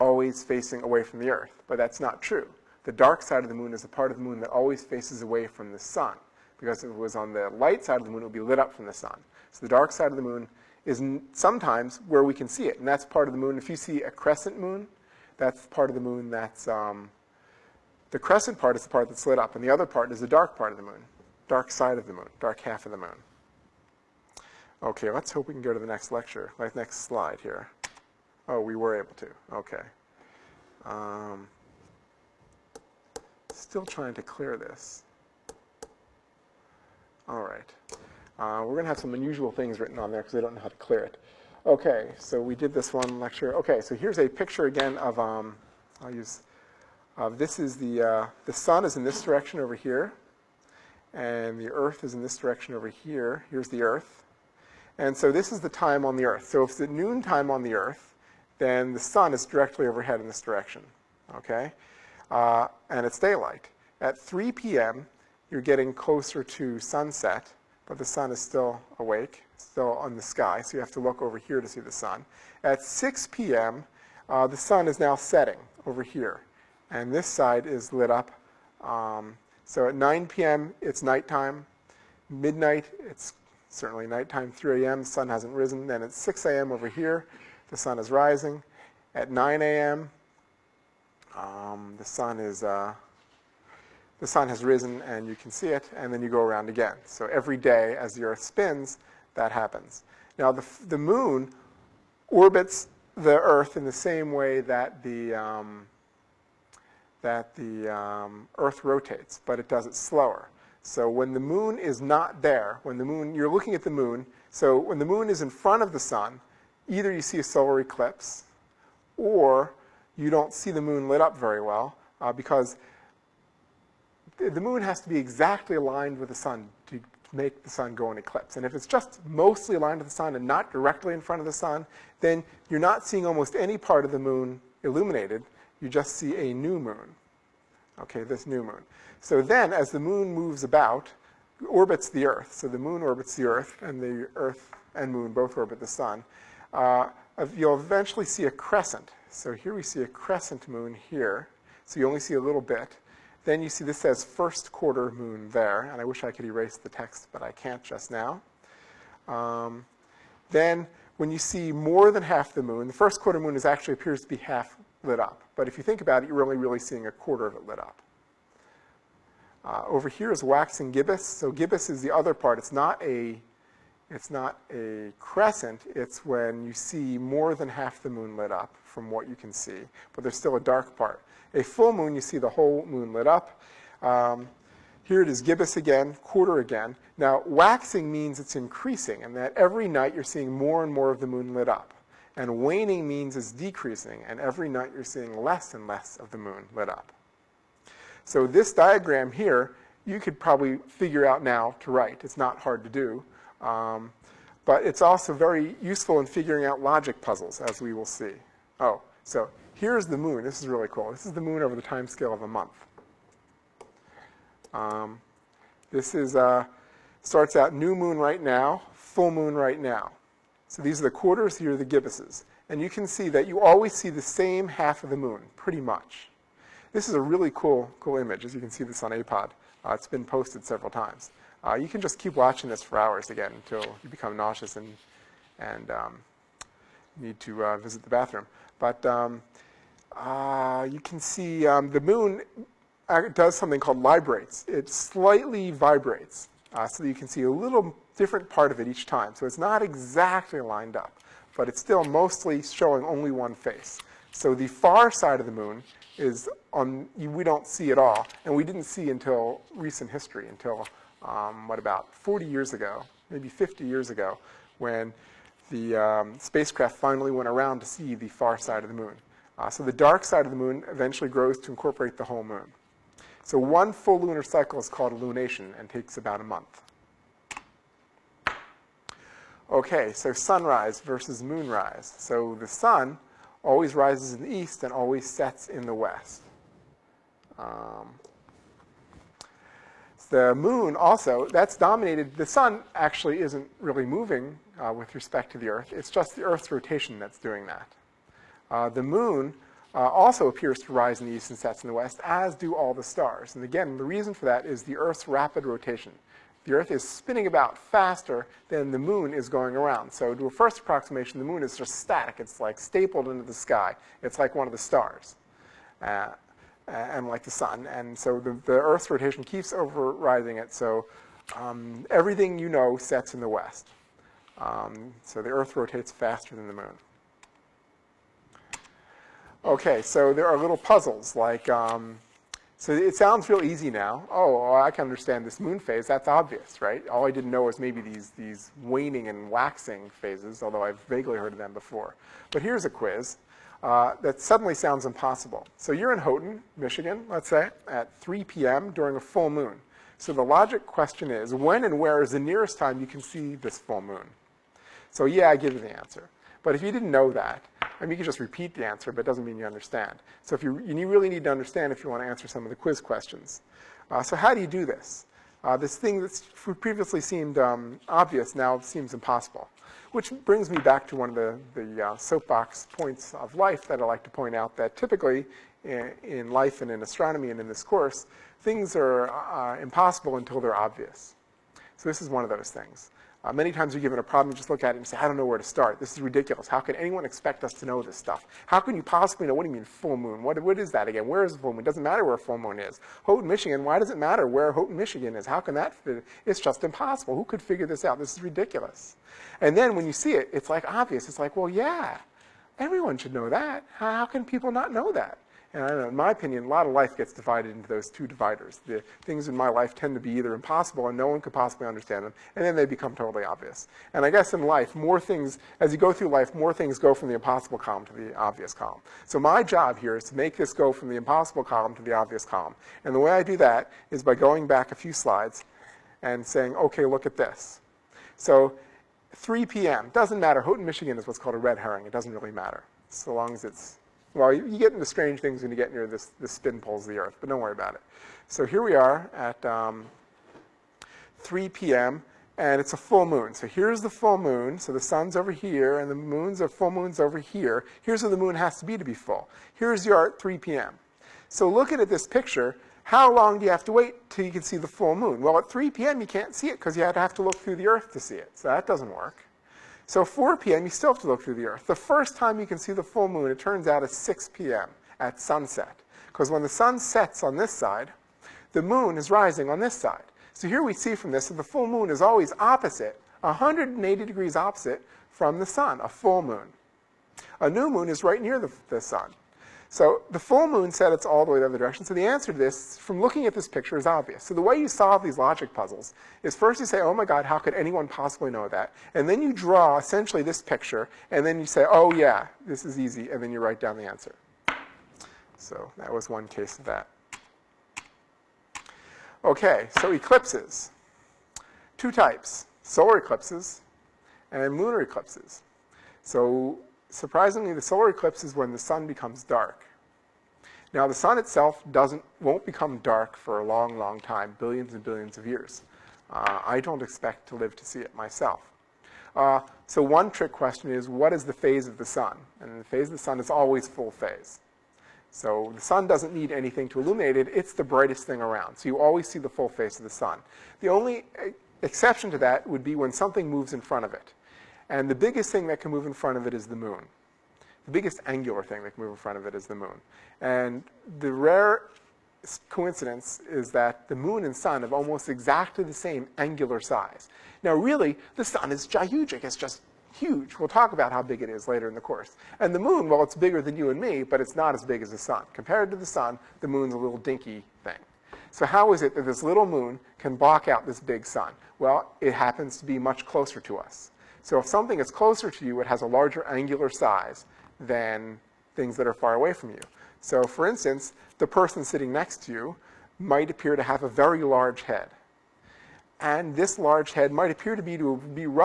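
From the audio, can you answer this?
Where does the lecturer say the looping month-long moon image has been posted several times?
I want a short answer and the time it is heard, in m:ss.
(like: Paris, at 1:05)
APOD, at 3:49.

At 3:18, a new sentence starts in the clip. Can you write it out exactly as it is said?
So this diagram here, you could probably figure out now to write.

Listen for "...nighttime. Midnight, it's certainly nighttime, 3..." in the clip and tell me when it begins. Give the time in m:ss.
1:21.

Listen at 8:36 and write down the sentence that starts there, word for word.
Uh, I don't expect to live to see it myself.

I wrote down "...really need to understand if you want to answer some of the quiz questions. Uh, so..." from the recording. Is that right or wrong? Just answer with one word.
right.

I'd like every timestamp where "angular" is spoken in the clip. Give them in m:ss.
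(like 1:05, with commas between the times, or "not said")
8:58, 9:06, 9:26.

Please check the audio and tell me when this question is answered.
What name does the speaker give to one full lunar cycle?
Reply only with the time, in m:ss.
4:35.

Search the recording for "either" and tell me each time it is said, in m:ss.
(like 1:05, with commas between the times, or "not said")
1:56, 6:50.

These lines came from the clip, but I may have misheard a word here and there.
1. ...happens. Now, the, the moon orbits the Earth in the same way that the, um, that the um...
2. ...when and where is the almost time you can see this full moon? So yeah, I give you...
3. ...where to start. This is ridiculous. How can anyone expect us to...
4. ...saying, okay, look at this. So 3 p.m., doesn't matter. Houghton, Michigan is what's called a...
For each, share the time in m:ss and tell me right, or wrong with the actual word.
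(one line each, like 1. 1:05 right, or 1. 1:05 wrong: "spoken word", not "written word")
1. 1:39 right
2. 5:51 wrong: "nearest", not "almost"
3. 6:25 right
4. 7:06 right.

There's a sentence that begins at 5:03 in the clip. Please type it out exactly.
And again, the reason for that is the Earth's rapid rotation.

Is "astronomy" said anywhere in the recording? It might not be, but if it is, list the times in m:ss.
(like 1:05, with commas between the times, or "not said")
6:17.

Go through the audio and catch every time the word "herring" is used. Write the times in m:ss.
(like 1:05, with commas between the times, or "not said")
7:11.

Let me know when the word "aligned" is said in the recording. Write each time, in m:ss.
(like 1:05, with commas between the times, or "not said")
2:05, 2:09.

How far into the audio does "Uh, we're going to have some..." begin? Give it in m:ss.
0:38.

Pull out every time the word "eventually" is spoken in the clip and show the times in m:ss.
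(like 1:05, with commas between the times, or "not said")
2:27, 4:30.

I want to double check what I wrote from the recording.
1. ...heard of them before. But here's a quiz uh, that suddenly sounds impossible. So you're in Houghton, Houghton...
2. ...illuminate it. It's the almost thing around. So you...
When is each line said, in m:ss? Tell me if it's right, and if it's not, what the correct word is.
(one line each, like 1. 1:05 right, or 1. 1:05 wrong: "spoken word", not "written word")
1. 5:41 wrong: "Michigan", not "Houghton"
2. 8:47 wrong: "brightest", not "almost".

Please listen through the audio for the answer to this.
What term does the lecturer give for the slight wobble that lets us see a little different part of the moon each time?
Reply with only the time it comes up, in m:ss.
4:04.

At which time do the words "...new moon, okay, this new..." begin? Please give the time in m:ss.
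2:16.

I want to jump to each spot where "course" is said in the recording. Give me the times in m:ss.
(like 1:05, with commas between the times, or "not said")
6:17, 9:12.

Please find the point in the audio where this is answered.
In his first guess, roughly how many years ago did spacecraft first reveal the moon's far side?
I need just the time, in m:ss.
4:22.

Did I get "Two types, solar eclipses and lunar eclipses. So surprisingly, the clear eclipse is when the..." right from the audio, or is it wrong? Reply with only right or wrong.
wrong.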